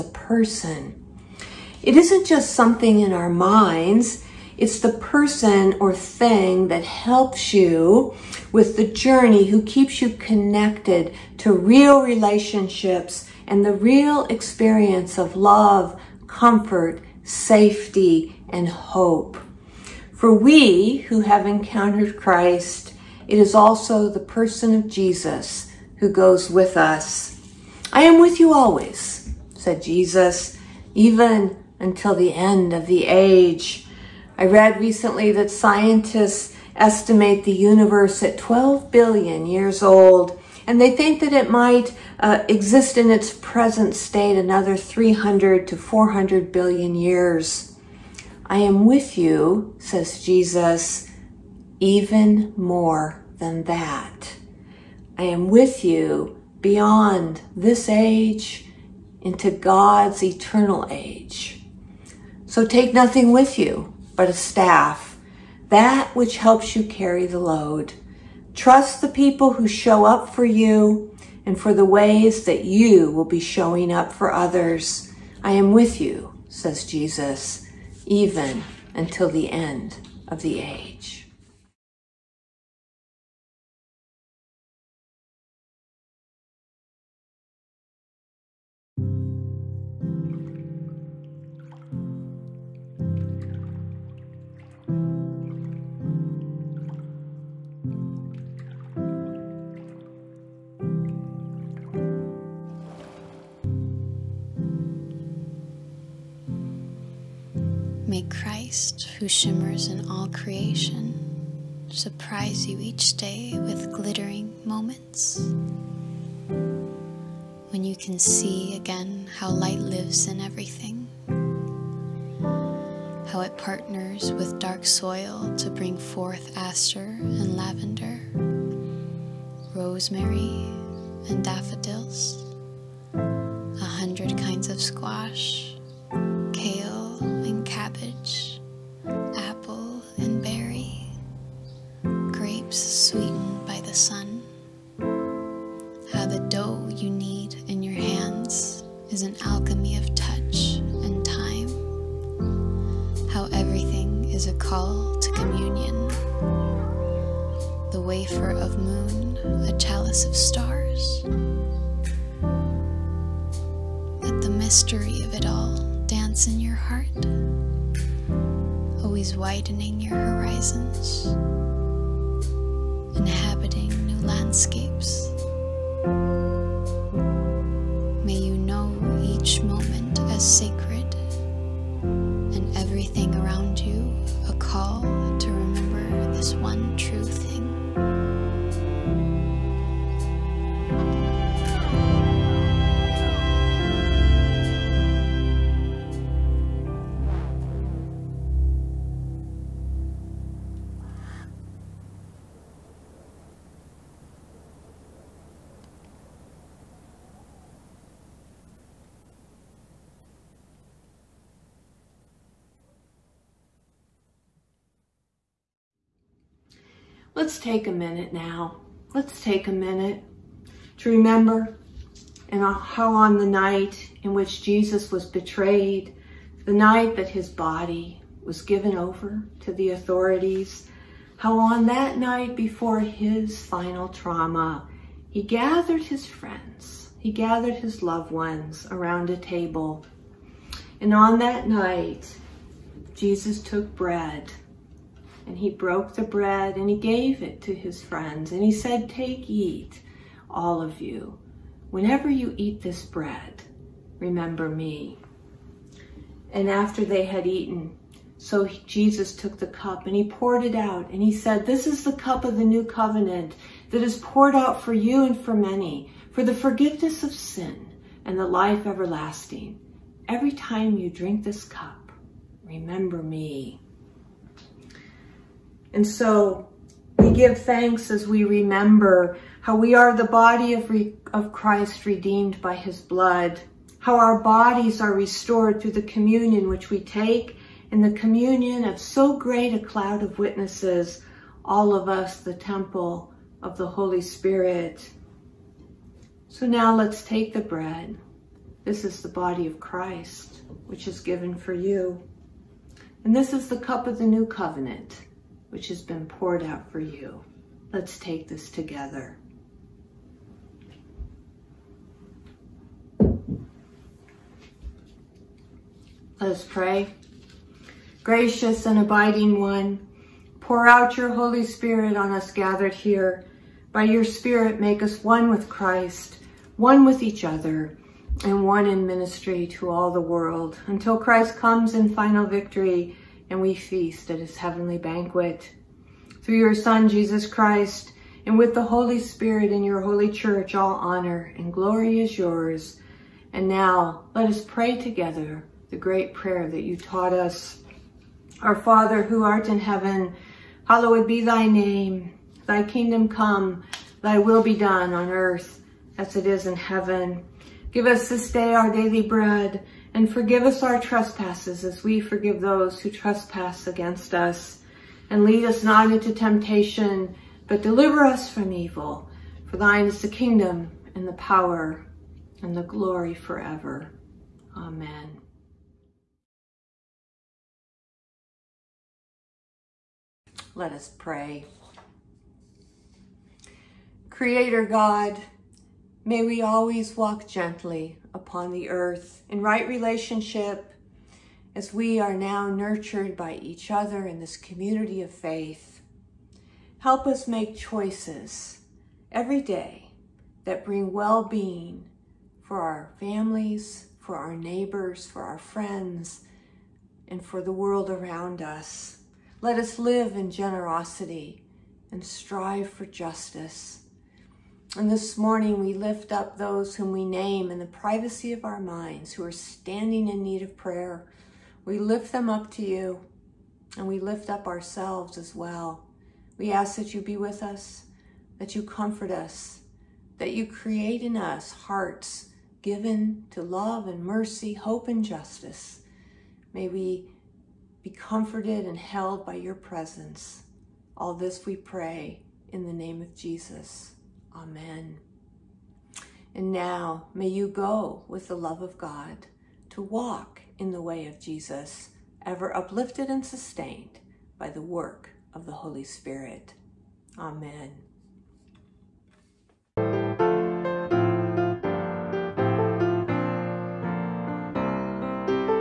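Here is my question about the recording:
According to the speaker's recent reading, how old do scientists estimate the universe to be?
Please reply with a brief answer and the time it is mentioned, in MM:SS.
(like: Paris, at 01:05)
12 billion years, at 00:38.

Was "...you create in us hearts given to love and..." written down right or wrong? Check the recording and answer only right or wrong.
right.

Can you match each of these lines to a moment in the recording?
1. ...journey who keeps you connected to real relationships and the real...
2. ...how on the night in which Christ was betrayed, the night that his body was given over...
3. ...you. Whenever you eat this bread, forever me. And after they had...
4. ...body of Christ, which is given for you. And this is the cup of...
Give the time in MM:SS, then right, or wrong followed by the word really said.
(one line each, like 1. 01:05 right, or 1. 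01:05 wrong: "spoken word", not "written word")
1. 00:08 right
2. 03:42 wrong: "Jesus", not "Christ"
3. 04:11 wrong: "remember", not "forever"
4. 04:59 right.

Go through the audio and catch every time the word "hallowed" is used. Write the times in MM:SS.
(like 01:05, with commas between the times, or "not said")
05:50.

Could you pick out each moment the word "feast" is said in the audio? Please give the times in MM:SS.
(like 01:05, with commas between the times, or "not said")
05:33.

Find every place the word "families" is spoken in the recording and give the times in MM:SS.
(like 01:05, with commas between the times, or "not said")
06:43.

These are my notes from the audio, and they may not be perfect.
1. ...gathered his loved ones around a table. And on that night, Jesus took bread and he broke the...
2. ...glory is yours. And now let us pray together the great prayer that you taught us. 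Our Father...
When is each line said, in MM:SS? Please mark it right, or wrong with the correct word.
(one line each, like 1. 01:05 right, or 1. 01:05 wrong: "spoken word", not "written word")
1. 03:57 right
2. 05:41 right.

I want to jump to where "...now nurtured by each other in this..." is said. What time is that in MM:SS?
06:32.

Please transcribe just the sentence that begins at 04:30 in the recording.
Every time you drink this cup, remember me.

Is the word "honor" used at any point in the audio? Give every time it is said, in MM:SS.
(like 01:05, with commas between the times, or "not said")
05:40.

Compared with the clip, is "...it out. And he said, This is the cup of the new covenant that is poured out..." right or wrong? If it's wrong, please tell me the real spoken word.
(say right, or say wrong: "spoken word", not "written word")
right.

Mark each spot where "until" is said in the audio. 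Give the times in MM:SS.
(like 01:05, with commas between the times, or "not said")
00:31, 01:18, 05:30.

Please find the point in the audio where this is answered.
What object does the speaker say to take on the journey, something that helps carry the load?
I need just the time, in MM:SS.
01:04.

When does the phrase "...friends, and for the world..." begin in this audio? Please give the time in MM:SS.
06:45.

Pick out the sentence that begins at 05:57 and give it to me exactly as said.
Give us this day our daily bread and forgive us our trespasses as we forgive those who trespass against us.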